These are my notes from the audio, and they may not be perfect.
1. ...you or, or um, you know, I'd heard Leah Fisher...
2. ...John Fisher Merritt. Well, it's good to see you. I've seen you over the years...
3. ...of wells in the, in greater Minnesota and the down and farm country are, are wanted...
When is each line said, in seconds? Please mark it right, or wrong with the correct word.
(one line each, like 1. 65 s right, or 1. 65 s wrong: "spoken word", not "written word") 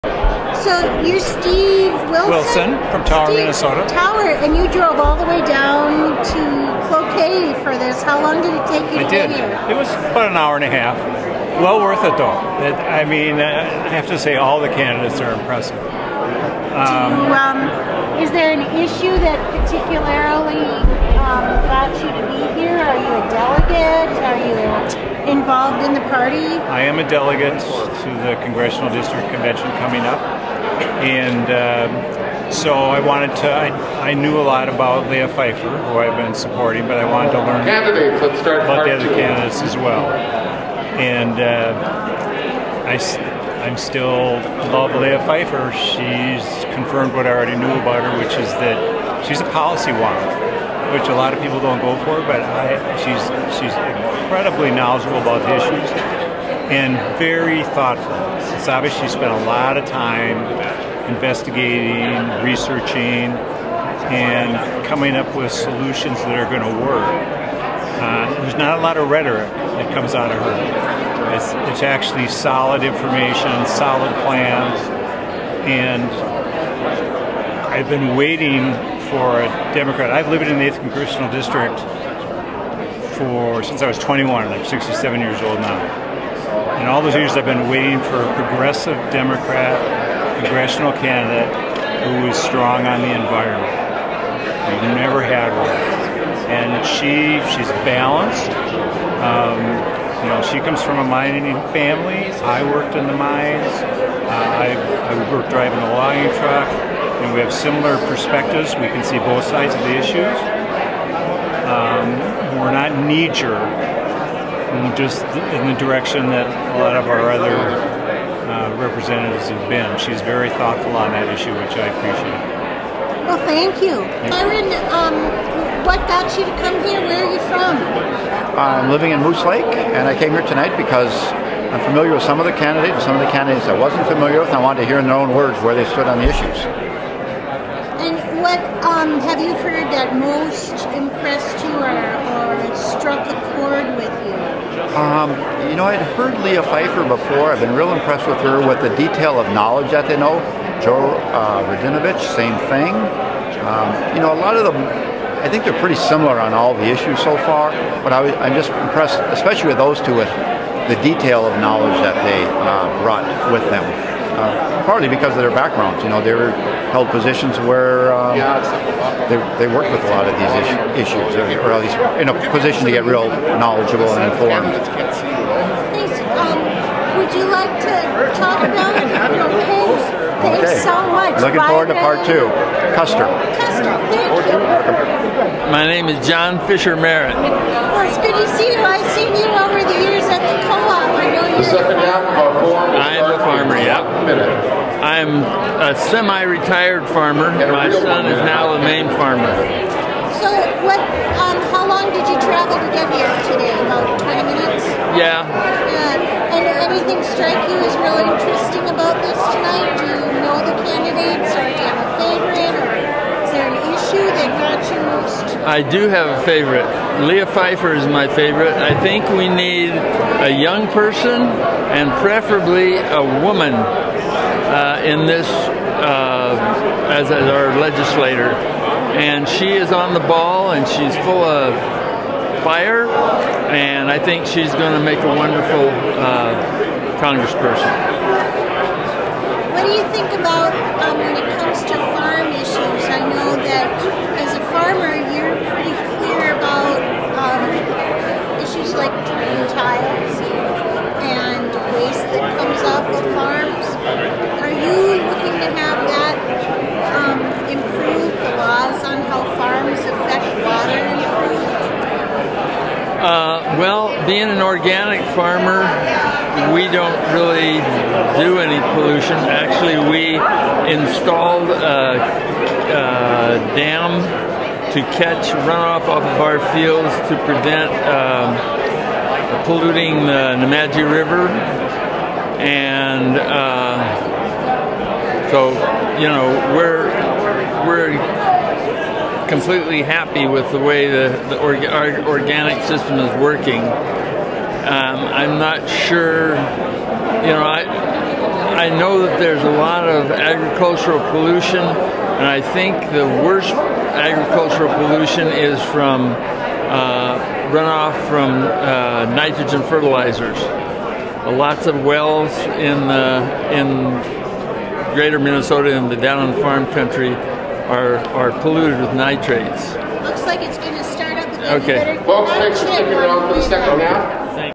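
1. 141 s wrong: "Phifer", not "Fisher"
2. 186 s right
3. 311 s wrong: "polluted", not "wanted".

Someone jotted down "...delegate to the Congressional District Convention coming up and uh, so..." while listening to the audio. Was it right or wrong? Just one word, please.
right.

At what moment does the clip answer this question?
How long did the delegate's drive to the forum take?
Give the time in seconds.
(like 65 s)
10 s.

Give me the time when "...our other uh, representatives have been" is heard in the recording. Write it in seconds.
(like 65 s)
117 s.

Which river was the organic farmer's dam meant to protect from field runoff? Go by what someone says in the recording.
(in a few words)
Nemadji River.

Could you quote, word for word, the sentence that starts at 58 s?
It's obvious she spent a lot of time investigating, researching, and coming up with solutions that are going to work.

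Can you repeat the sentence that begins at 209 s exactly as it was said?
Do you know the candidates, or do you have a favorite, or is there an issue that got you most?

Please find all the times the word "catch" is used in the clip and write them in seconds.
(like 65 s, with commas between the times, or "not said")
275 s.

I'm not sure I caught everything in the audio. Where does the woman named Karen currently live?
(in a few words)
Moose Lake.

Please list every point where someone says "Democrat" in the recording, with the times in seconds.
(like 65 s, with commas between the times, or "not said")
79 s, 89 s.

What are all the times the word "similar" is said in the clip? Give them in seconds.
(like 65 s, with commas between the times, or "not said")
107 s, 155 s.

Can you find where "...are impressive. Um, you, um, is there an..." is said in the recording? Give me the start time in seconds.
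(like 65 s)
15 s.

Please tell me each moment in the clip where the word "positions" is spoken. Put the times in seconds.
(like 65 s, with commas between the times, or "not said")
167 s, 172 s.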